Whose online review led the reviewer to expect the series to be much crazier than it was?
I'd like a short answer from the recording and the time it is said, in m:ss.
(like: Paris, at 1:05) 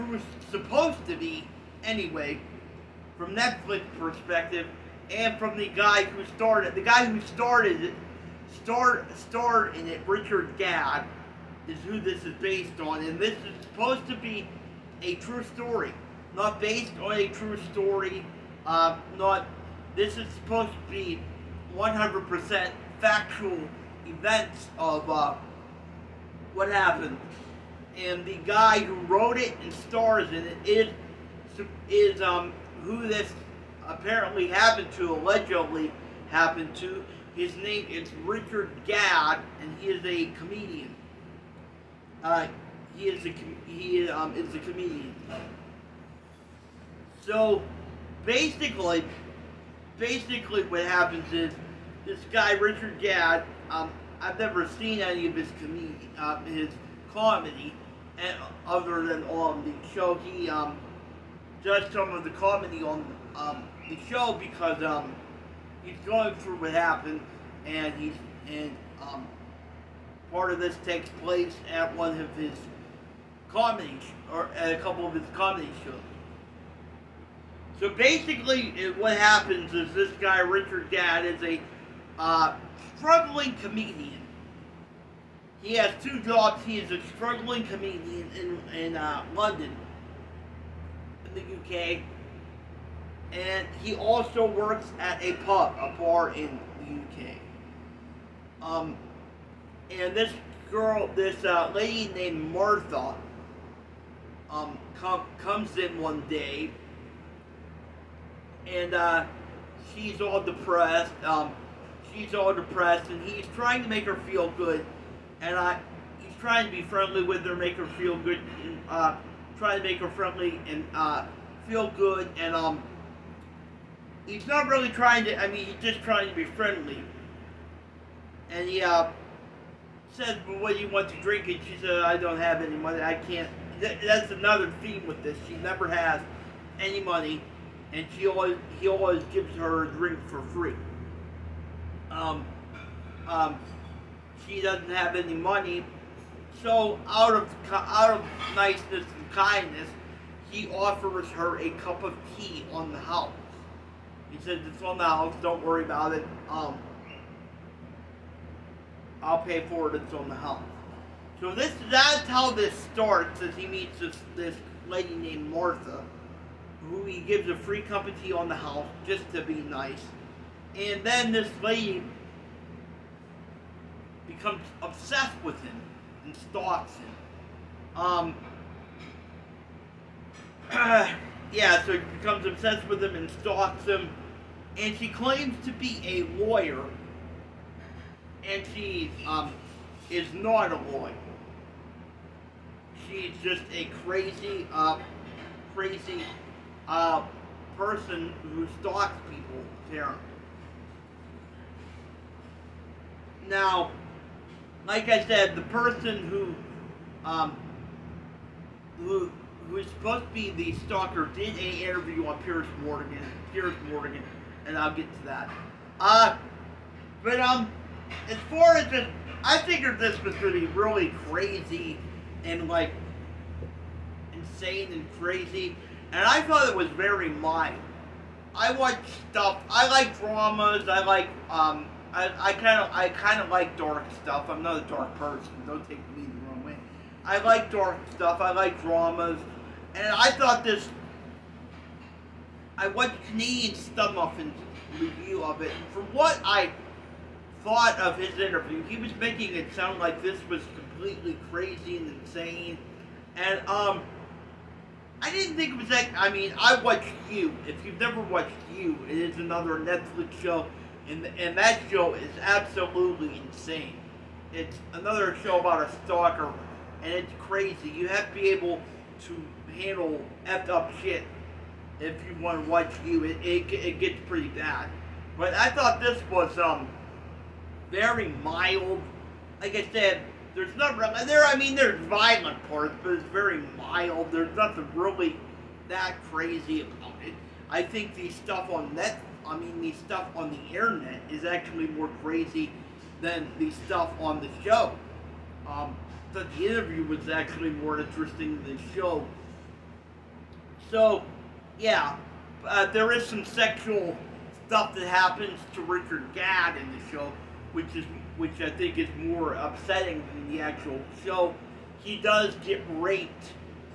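Canadian Stud Muffin, at 4:03.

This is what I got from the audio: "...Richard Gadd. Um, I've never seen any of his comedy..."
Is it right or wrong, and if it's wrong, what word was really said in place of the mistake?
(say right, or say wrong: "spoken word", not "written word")
right.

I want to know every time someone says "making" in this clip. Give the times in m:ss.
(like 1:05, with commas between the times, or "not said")
4:09.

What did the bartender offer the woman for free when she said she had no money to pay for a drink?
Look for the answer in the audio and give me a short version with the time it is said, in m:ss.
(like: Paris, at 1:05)
A cup of tea, at 2:31.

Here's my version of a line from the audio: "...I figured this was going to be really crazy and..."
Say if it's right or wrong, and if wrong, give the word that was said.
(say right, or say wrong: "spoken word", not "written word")
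right.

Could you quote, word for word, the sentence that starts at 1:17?
So basically, what happens is this guy Richard Gadd is a uh, struggling comedian.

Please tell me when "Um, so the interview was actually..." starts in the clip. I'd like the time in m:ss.
4:55.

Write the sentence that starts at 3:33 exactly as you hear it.
Piers Morgan and I'll get to that.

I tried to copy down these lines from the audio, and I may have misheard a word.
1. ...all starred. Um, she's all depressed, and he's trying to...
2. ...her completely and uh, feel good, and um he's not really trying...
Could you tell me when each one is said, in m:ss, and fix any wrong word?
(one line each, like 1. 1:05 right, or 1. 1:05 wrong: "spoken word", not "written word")
1. 1:50 wrong: "depressed", not "starred"
2. 1:59 wrong: "friendly", not "completely".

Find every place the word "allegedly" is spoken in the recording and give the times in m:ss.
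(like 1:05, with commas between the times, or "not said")
0:35.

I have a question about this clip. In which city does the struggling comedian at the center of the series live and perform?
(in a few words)
London.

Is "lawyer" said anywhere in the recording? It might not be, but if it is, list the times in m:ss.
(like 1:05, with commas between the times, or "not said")
3:06, 3:10.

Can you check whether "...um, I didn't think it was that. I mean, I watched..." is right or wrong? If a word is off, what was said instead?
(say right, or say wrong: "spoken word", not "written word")
right.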